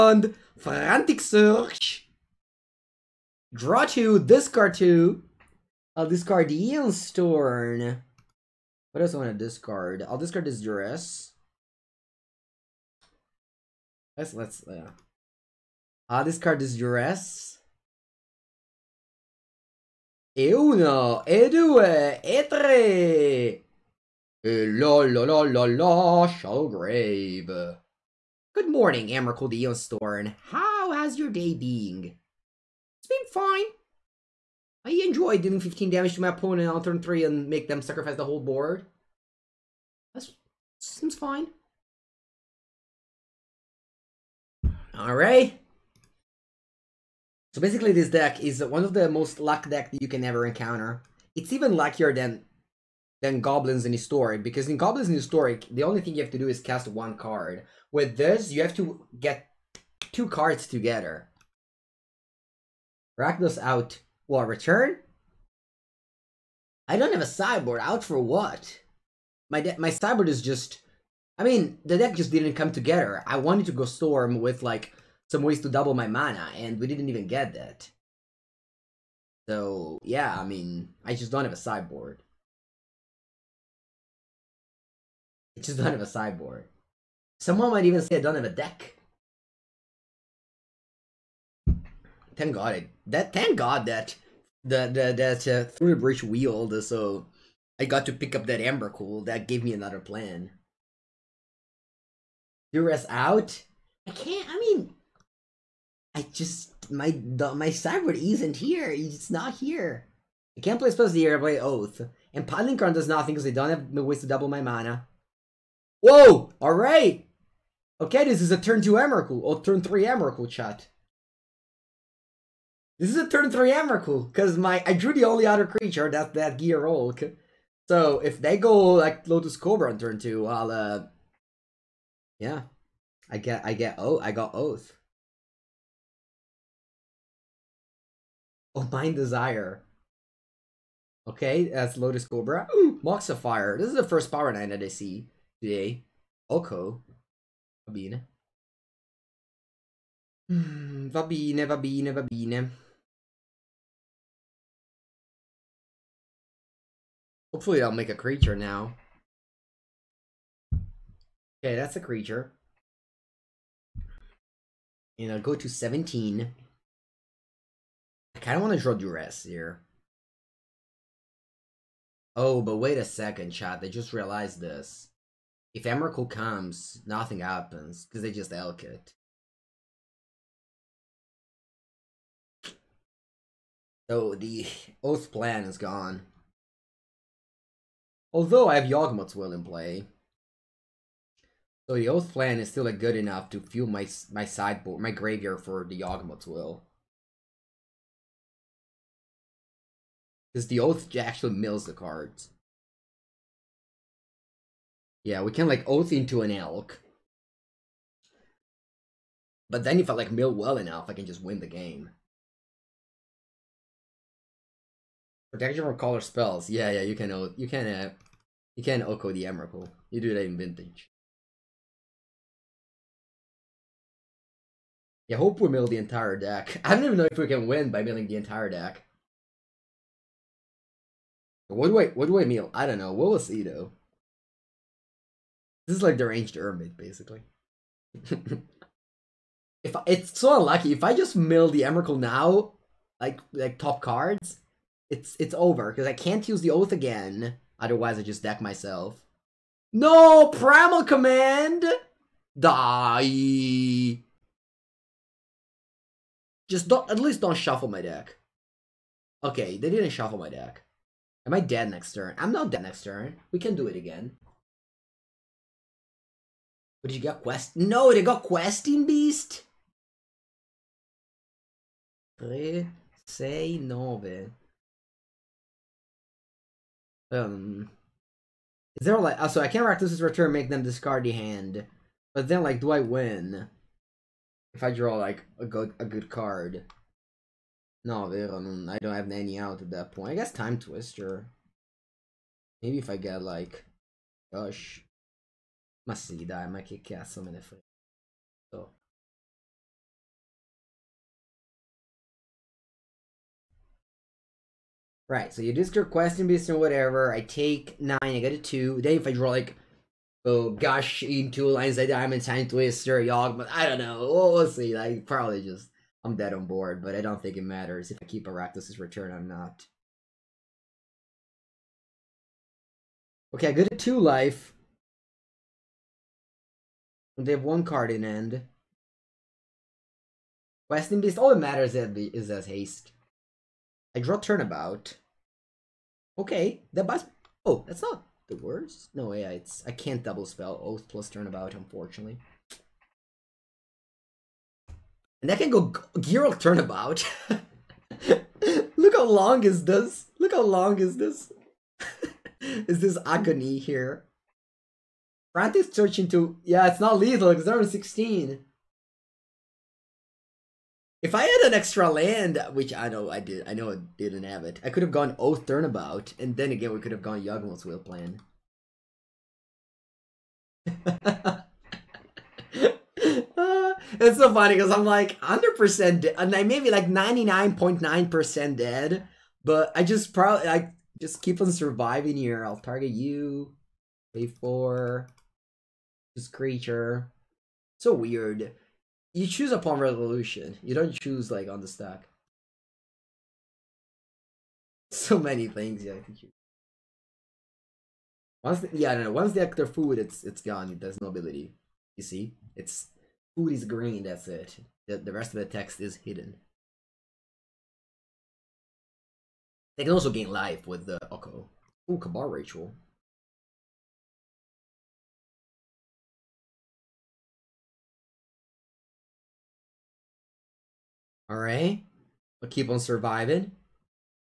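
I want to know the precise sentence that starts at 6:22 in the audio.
I'll target you, pay 4 this creature.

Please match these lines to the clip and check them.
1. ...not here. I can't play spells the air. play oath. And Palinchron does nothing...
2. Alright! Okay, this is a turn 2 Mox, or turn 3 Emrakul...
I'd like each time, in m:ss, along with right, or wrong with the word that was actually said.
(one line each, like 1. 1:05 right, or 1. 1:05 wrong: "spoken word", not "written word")
1. 1:49 right
2. 1:56 wrong: "Emrakul", not "Mox".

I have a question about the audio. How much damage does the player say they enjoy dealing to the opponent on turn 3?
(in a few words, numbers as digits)
15.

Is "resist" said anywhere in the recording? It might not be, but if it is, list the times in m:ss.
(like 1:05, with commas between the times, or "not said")
not said.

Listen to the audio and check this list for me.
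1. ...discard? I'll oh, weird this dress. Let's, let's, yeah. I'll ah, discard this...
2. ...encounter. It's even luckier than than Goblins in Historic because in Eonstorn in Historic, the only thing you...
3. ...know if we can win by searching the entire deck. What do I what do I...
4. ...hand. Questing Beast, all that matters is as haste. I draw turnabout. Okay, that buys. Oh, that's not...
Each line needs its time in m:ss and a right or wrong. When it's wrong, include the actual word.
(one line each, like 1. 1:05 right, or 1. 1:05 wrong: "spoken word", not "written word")
1. 0:09 wrong: "discard", not "weird"
2. 0:50 wrong: "Goblins", not "Eonstorn"
3. 3:47 wrong: "milling", not "searching"
4. 5:28 right.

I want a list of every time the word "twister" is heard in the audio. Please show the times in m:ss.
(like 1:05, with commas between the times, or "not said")
4:50, 5:12.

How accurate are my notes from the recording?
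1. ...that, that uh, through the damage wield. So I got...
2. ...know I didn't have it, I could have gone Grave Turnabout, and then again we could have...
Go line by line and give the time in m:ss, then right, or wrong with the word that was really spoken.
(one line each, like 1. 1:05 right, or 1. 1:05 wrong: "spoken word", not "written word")
1. 1:34 wrong: "bridge", not "damage"
2. 6:03 wrong: "Oath", not "Grave".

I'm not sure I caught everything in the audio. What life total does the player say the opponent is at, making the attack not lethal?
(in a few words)
16.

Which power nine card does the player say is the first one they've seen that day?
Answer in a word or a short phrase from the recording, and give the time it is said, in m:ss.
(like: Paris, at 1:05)
Mox Sapphire, at 2:23.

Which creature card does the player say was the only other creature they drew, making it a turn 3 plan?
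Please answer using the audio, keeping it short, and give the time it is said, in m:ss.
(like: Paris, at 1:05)
Gearhulk, at 2:06.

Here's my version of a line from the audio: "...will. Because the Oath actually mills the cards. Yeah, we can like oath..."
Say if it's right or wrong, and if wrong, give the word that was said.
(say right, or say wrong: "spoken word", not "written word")
right.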